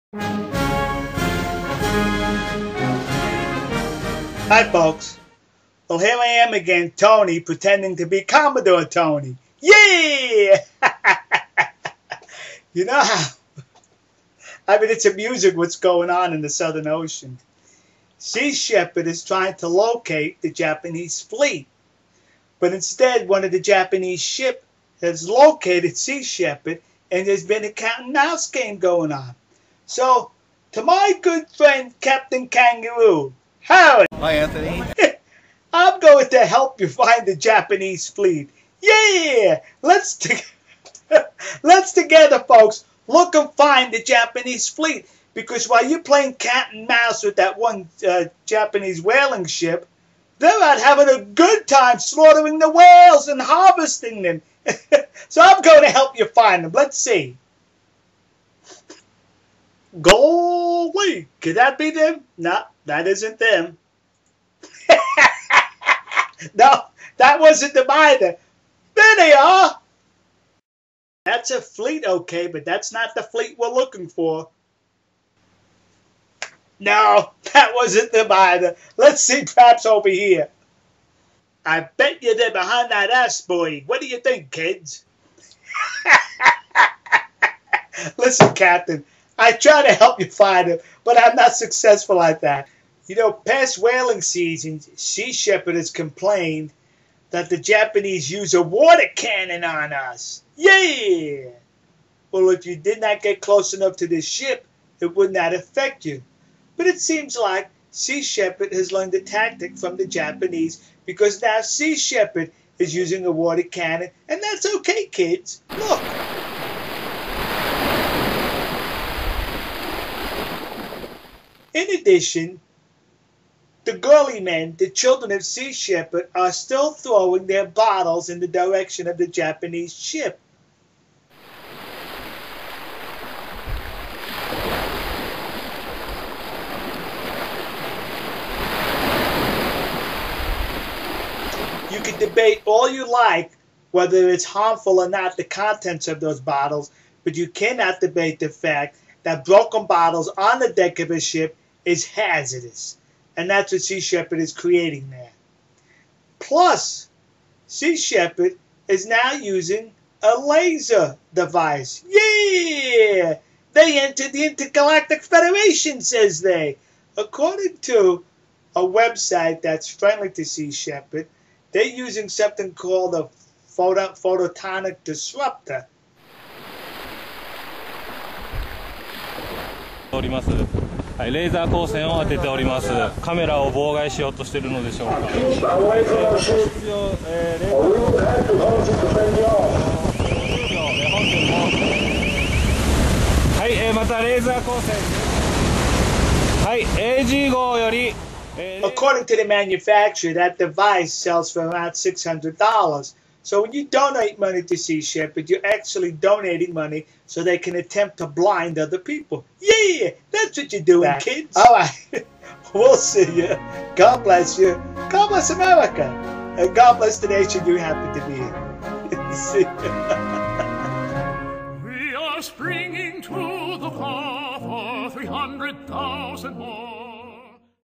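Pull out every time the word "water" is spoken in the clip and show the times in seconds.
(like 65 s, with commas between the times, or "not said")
98 s, 113 s.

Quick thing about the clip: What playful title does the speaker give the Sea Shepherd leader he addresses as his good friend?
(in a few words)
Captain Kangaroo.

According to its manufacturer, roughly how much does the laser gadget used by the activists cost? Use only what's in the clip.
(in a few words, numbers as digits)
$600.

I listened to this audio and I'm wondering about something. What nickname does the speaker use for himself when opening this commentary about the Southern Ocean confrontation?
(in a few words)
Commodore Tony.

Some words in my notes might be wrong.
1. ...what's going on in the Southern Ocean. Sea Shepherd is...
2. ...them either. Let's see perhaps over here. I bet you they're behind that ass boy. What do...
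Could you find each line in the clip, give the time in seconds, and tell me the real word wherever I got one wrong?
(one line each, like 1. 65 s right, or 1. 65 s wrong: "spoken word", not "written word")
1. 15 s right
2. 78 s right.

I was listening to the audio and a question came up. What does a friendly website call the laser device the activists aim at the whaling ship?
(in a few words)
photonic disruptor.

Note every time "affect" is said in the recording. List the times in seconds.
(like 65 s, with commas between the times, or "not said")
105 s.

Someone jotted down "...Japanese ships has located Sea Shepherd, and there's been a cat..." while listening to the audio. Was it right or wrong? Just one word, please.
right.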